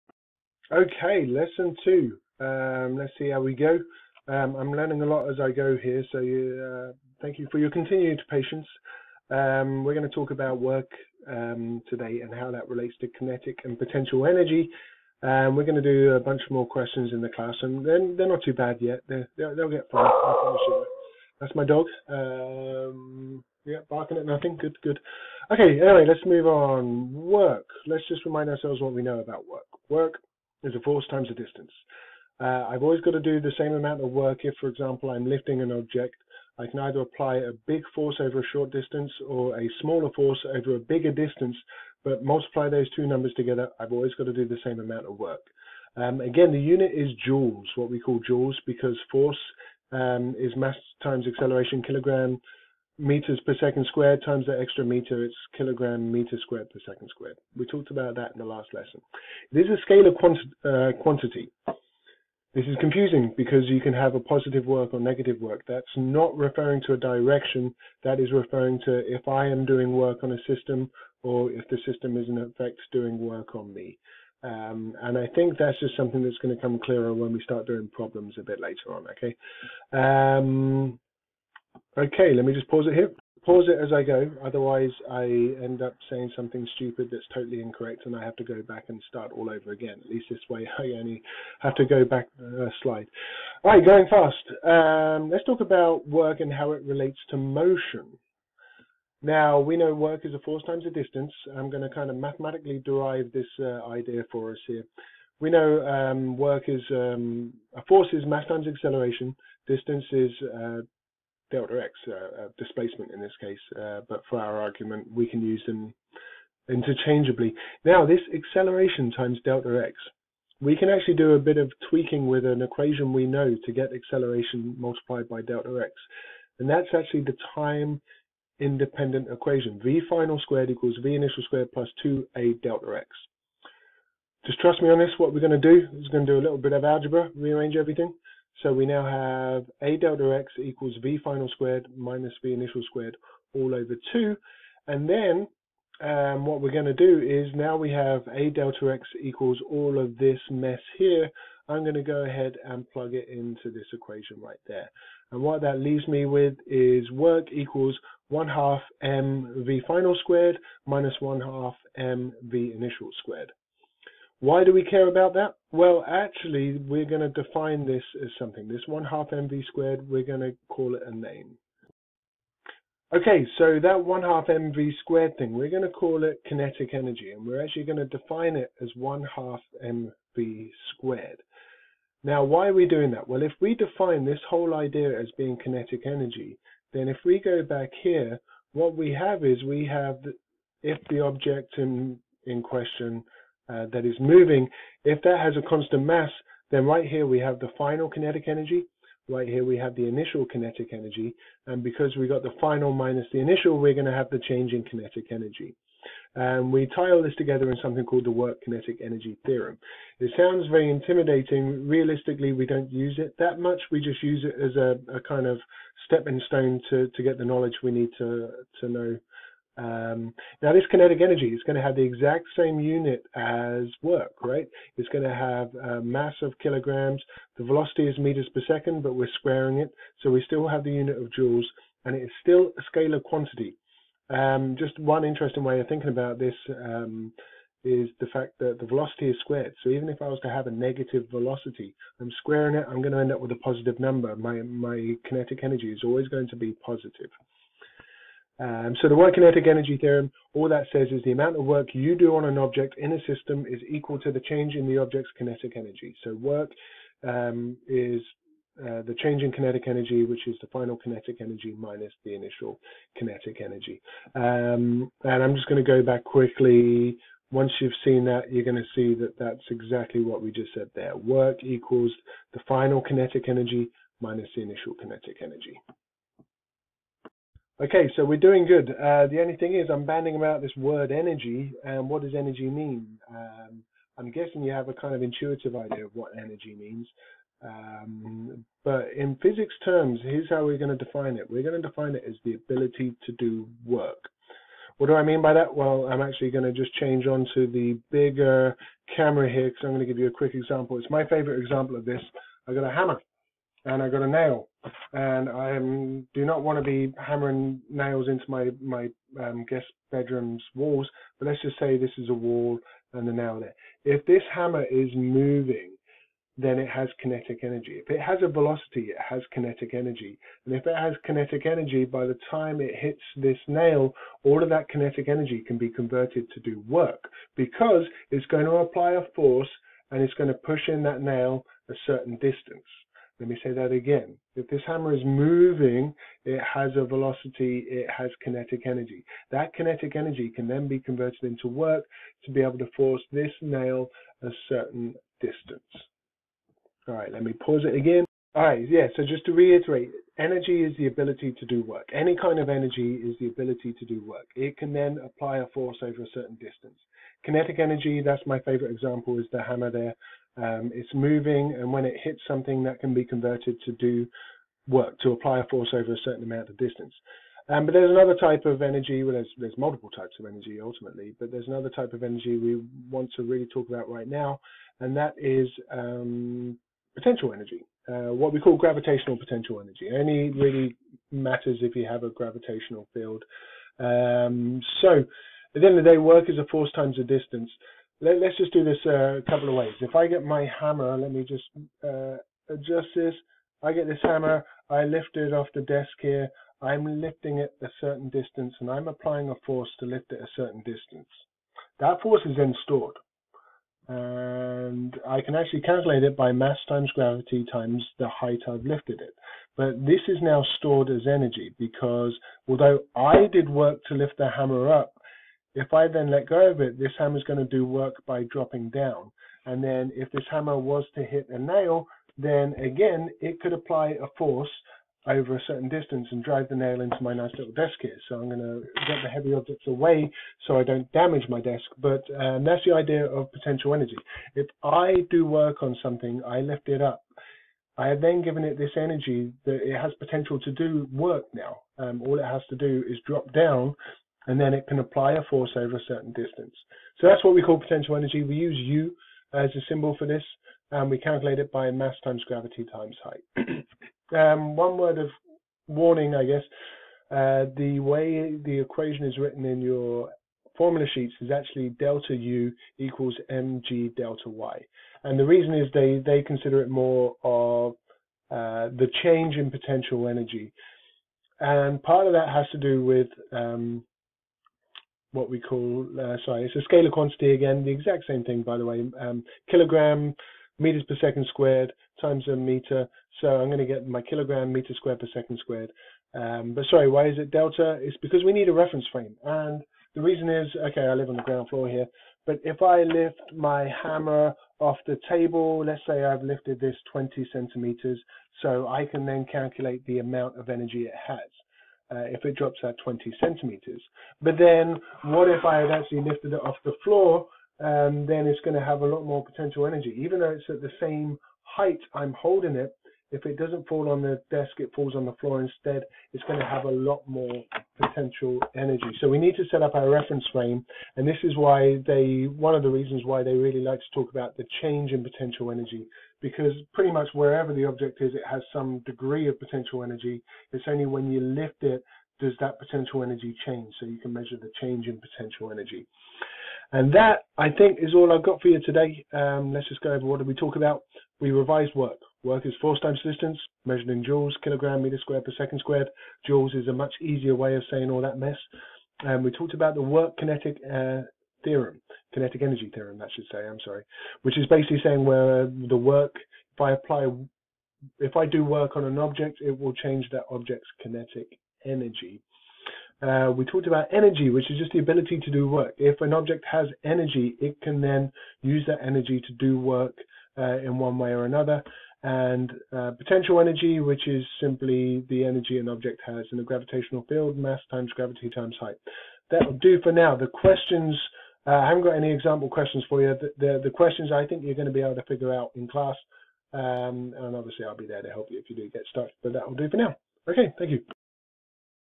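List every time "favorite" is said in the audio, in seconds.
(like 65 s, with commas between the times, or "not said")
301 s, 358 s.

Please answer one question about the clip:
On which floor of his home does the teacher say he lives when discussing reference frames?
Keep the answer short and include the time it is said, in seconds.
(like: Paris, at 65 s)
ground floor, at 491 s.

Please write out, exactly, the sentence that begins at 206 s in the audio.
And we tie all this together in something called the work kinetic energy theorem.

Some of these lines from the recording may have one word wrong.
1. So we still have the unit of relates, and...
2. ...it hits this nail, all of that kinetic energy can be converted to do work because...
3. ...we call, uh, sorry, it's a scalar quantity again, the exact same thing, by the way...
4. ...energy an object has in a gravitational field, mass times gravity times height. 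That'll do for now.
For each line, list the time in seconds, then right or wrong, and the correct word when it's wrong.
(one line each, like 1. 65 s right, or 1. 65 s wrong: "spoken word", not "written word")
1. 230 s wrong: "joules", not "relates"
2. 322 s right
3. 475 s right
4. 575 s right.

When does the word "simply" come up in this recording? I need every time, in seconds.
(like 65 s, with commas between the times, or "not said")
574 s.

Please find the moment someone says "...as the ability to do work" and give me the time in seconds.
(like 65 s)
292 s.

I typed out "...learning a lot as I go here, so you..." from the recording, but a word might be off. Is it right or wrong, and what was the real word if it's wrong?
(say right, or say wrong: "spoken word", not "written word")
right.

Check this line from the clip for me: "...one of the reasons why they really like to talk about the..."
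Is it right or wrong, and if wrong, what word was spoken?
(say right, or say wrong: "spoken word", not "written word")
right.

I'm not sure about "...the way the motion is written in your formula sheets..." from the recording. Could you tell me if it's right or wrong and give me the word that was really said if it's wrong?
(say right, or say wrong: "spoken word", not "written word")
wrong: "equation", not "motion".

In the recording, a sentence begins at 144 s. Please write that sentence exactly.
And then um, what we're going to do is now we have a delta x equals all of this mess here.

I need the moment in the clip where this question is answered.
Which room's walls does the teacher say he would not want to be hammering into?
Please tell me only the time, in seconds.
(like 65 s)
309 s.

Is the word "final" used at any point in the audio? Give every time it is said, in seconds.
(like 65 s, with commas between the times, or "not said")
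130 s, 141 s, 159 s, 197 s, 202 s, 260 s, 272 s.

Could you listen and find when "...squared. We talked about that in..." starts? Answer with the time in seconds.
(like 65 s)
57 s.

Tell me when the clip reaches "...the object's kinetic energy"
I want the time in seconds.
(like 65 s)
254 s.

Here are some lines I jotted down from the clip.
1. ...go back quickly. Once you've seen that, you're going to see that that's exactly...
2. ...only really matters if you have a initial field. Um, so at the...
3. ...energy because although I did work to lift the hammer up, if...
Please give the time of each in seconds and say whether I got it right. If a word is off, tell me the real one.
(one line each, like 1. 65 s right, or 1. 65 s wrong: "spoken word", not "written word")
1. 265 s right
2. 380 s wrong: "gravitational", not "initial"
3. 411 s right.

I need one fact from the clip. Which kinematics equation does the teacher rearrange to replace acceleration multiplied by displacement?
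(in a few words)
time independent equation.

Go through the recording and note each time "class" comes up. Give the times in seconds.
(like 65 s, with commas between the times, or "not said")
17 s, 585 s.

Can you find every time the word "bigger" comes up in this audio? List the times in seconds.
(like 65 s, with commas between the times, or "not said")
40 s, 298 s.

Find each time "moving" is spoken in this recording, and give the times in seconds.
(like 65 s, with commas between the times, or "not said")
194 s, 315 s, 335 s, 361 s.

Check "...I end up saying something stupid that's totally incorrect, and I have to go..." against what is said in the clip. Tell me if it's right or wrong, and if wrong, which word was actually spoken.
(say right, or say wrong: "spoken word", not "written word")
right.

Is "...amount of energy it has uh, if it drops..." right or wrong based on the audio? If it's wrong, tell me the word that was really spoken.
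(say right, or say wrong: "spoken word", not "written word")
right.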